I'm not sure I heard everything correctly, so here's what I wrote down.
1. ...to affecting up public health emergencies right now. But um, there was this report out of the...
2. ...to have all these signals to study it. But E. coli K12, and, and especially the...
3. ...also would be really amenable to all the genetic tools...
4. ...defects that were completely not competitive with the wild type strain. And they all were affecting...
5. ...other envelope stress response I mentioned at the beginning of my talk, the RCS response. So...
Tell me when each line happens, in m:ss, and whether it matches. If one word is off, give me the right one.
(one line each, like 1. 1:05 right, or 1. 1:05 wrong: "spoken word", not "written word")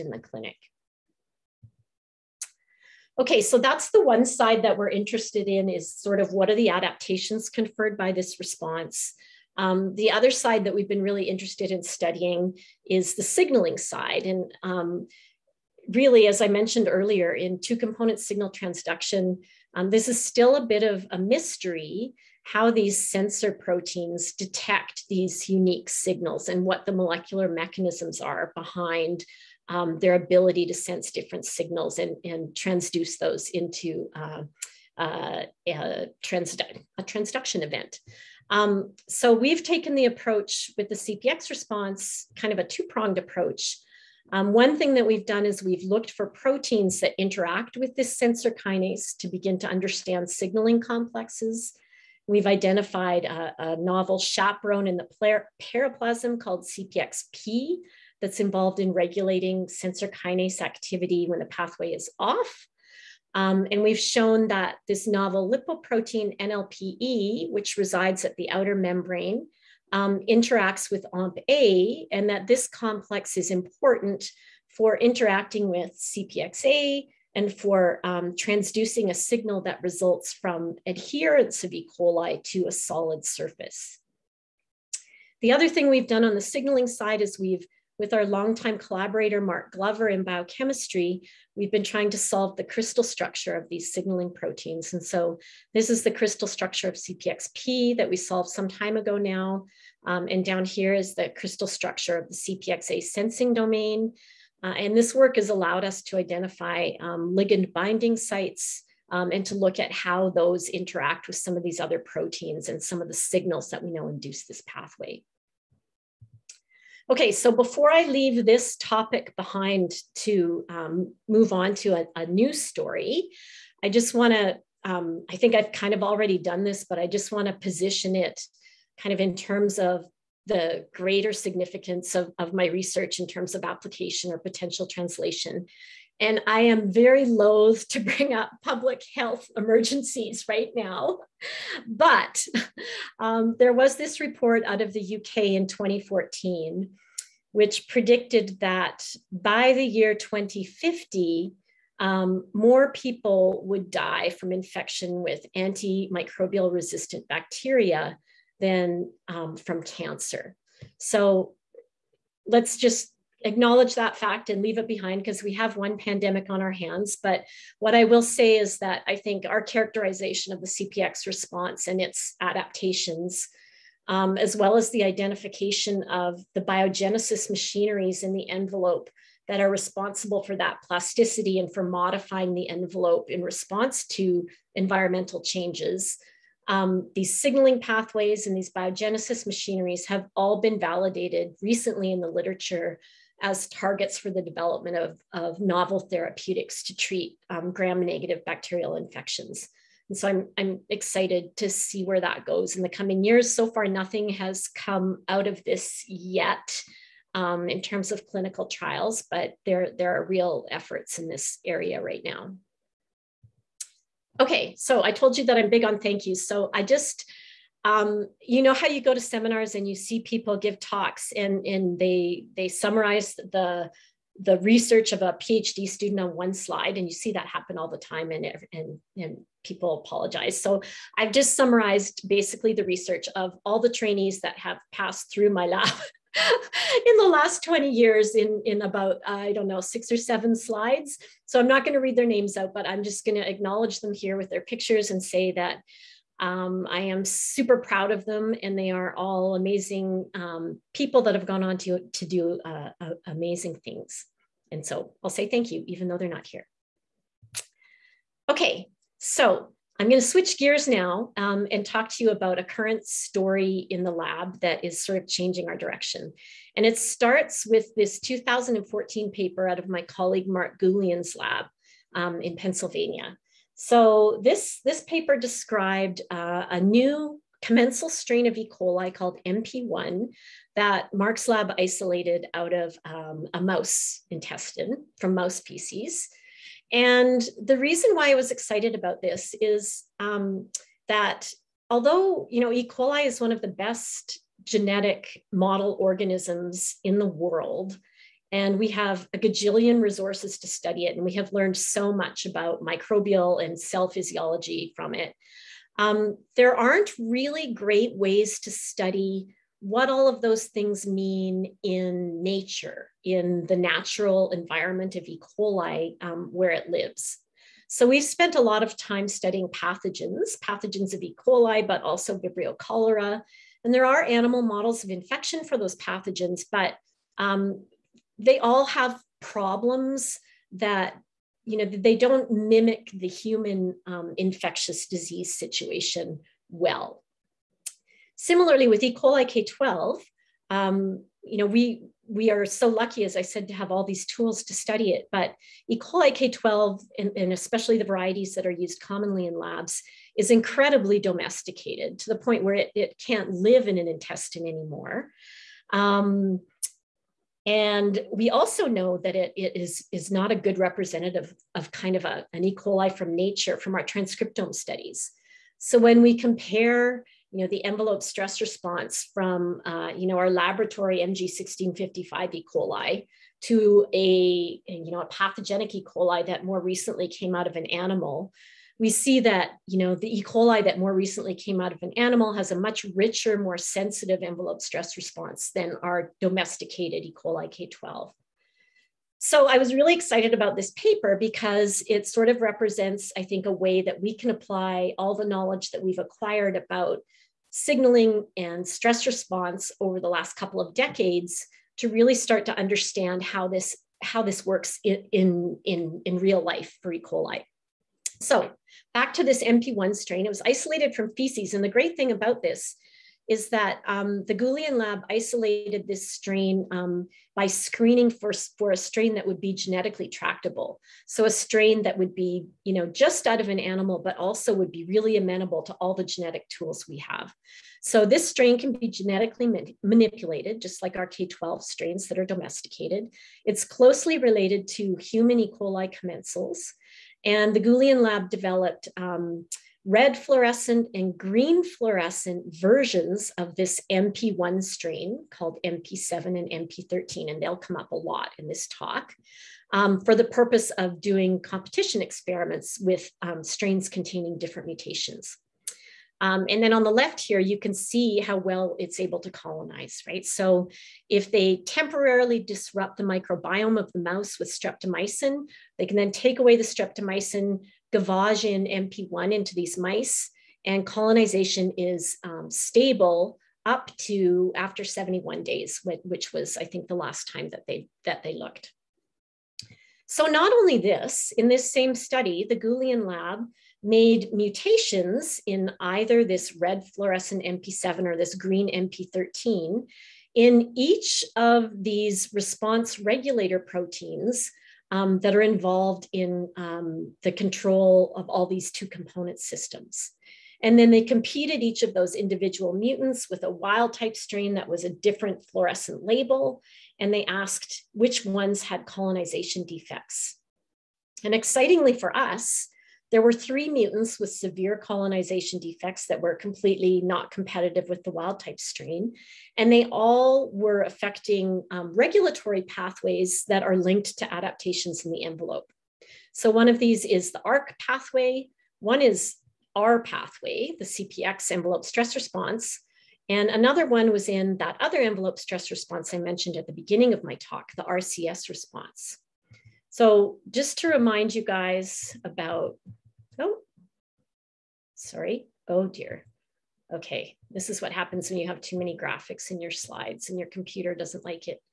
1. 2:17 wrong: "bring", not "affecting"
2. 5:43 wrong: "tools", not "signals"
3. 7:04 right
4. 8:35 right
5. 8:54 right.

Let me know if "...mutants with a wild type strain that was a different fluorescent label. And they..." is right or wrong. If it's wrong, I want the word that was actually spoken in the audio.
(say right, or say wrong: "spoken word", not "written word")
right.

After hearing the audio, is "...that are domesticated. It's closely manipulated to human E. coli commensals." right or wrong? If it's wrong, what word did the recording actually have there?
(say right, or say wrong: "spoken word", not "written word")
wrong: "related", not "manipulated".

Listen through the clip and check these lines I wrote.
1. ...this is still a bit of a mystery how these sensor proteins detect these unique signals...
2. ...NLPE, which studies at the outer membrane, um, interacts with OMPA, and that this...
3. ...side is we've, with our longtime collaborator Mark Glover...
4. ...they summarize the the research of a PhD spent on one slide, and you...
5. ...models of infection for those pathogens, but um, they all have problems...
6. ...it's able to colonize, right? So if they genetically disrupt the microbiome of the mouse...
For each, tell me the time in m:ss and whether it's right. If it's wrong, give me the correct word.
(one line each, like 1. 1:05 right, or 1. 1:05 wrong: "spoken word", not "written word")
1. 0:19 right
2. 1:06 wrong: "resides", not "studies"
3. 1:26 right
4. 3:42 wrong: "student", not "spent"
5. 5:24 right
6. 7:38 wrong: "temporarily", not "genetically".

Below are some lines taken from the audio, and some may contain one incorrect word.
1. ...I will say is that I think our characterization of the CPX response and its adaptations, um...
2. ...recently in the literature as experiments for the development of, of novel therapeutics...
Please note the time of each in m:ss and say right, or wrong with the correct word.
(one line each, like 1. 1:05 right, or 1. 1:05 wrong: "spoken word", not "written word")
1. 2:47 right
2. 3:11 wrong: "targets", not "experiments".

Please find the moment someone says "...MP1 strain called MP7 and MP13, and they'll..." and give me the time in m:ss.
7:24.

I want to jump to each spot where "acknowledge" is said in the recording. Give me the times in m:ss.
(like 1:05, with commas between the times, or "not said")
2:43, 4:03.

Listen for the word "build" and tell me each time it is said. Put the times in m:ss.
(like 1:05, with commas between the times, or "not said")
not said.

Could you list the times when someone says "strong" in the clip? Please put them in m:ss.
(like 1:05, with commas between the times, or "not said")
not said.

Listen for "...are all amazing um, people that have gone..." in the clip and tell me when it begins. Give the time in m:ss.
4:08.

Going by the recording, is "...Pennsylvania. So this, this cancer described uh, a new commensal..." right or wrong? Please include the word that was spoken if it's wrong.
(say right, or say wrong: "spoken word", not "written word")
wrong: "paper", not "cancer".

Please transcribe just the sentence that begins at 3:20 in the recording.
And so I'm, I'm excited to see where that goes in the coming years.